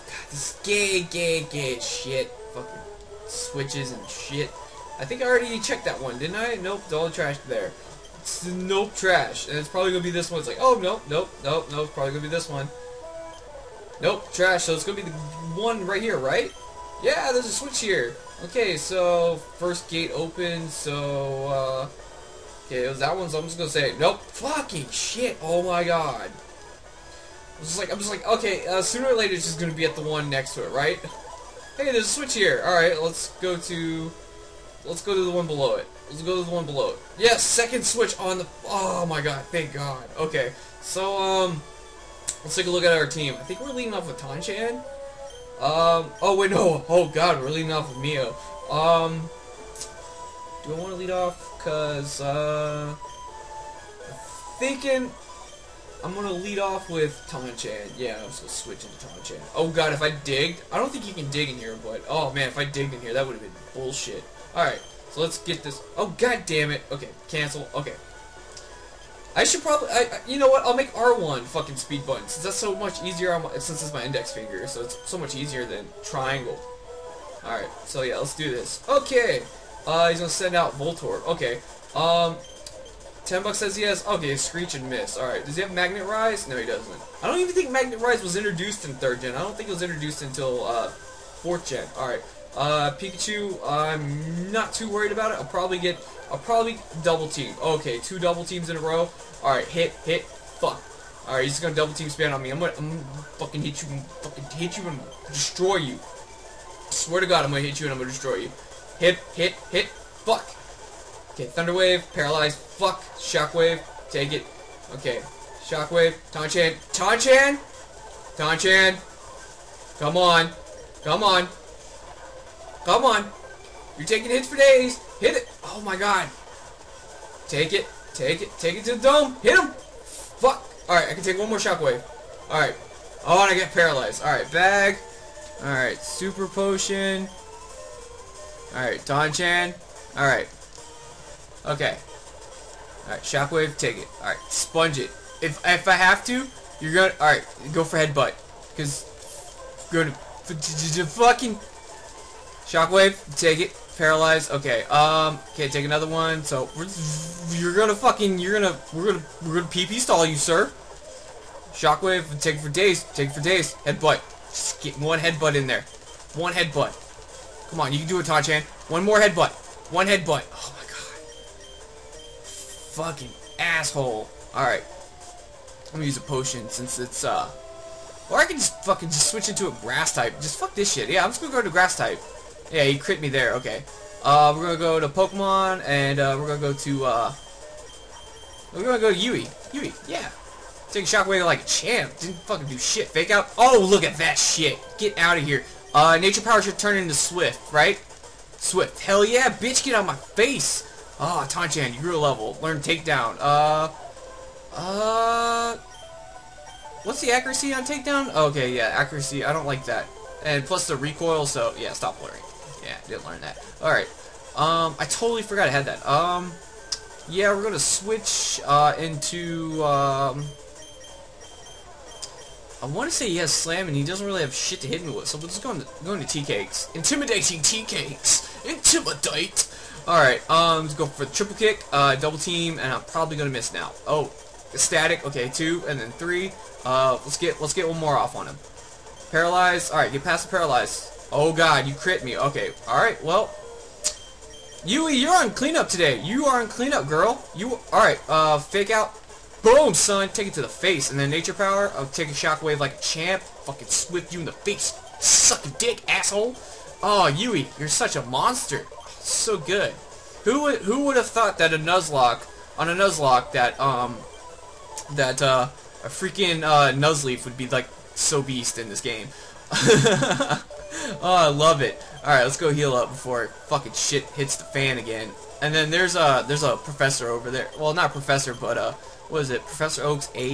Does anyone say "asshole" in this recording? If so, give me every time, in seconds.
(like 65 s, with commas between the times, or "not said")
173 s, 256 s.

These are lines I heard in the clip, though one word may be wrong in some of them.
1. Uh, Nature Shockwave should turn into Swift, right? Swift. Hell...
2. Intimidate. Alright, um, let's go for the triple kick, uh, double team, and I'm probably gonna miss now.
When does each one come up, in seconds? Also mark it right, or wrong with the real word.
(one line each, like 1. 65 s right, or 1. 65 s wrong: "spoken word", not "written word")
1. 195 s wrong: "Power", not "Shockwave"
2. 228 s right.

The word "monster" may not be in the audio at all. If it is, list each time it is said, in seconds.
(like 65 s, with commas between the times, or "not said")
258 s.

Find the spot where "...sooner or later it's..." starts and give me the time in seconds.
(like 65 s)
28 s.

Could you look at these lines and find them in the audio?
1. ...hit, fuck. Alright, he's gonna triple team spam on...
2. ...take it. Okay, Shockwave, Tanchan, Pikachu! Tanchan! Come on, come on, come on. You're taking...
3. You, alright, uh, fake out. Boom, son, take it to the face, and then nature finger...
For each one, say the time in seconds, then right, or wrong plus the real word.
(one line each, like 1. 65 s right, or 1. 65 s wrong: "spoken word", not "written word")
1. 100 s wrong: "double", not "triple"
2. 114 s wrong: "Tanchan", not "Pikachu"
3. 247 s wrong: "power", not "finger".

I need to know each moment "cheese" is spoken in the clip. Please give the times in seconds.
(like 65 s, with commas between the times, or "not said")
not said.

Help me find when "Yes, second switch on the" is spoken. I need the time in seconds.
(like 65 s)
37 s.